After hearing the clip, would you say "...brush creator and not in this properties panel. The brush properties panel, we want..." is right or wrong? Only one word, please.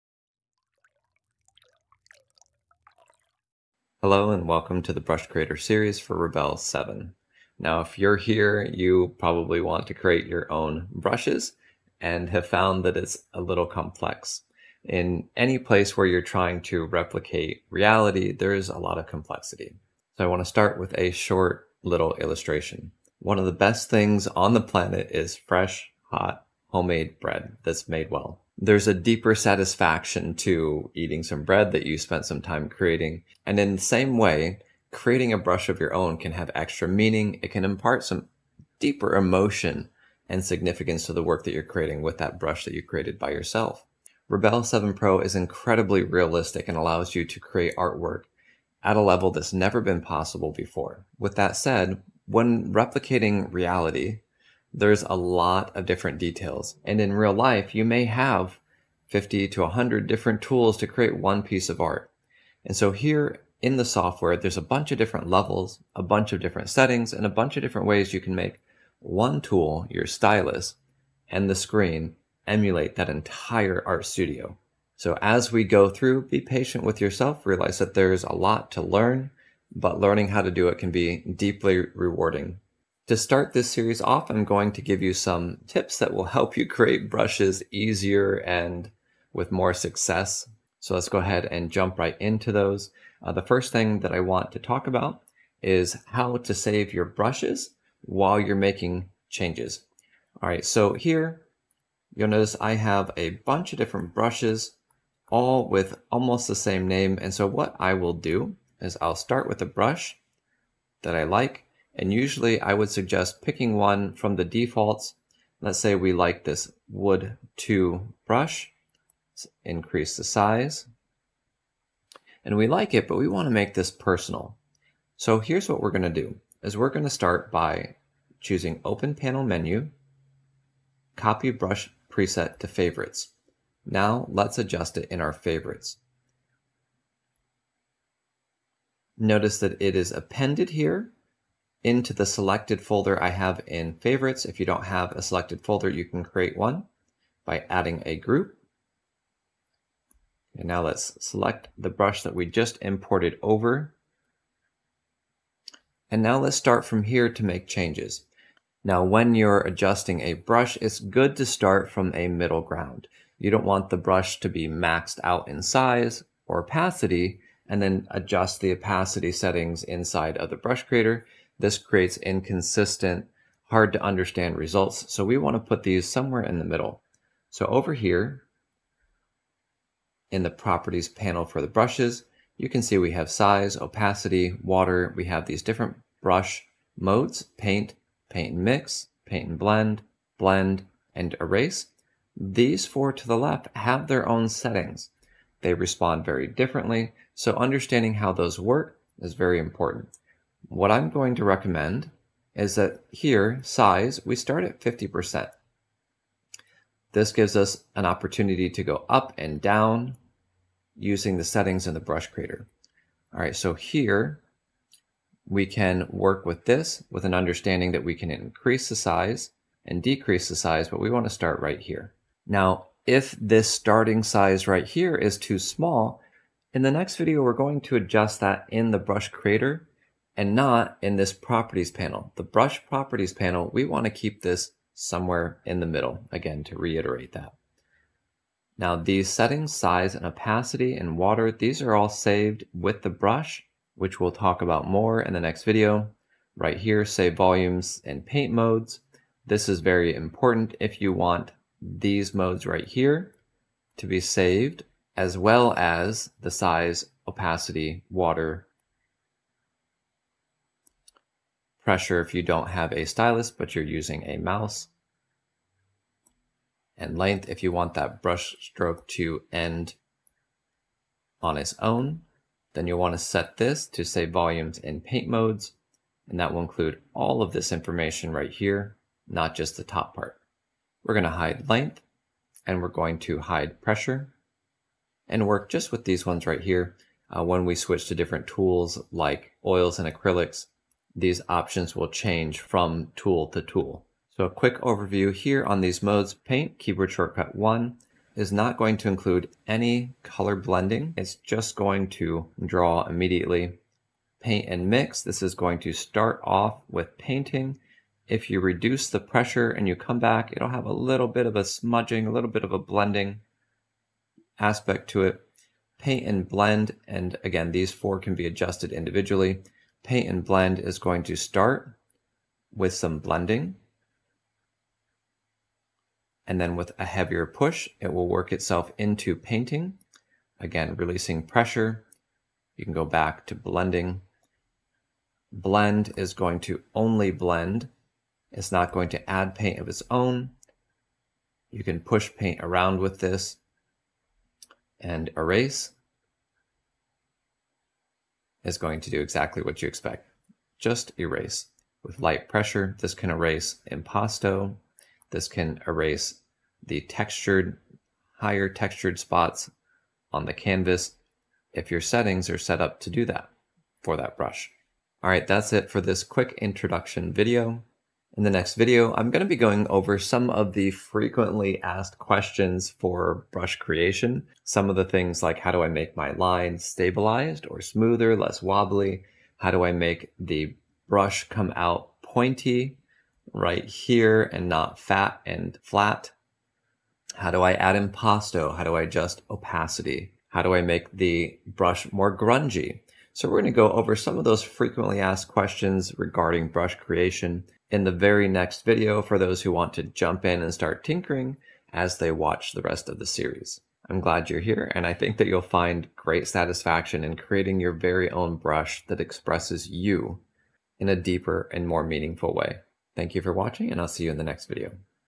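right.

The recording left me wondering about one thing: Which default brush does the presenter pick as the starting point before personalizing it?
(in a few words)
Wood two.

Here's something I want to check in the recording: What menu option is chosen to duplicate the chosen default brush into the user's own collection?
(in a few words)
Copy brush preset to favorites.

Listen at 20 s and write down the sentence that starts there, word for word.
So I want to start with a short little illustration.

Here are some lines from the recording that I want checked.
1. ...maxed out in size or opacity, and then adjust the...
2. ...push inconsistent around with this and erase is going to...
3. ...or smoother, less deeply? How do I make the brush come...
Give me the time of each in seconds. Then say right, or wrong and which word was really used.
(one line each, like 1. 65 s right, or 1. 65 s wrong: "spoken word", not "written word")
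1. 164 s right
2. 342 s wrong: "paint", not "inconsistent"
3. 377 s wrong: "wobbly", not "deeply".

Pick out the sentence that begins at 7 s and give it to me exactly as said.
Now, if you're here, you probably want to create your own brushes and have found that it's a little complex.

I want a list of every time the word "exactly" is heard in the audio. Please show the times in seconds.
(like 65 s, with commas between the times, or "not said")
349 s.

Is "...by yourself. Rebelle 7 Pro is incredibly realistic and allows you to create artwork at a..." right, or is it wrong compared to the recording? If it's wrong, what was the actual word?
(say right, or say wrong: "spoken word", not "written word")
right.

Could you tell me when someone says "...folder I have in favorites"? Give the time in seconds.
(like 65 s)
142 s.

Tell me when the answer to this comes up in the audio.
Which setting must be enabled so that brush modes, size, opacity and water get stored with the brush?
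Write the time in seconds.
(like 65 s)
247 s.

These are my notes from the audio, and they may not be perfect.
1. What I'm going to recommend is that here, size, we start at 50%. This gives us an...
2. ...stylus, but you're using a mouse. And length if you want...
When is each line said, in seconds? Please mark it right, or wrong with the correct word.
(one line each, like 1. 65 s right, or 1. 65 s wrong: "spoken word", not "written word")
1. 200 s right
2. 263 s right.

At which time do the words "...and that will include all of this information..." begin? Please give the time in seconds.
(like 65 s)
276 s.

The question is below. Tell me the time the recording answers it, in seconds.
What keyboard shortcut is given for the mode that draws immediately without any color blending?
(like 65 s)
297 s.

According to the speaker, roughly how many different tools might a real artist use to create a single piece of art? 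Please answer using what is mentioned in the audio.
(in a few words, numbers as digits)
50 to 100.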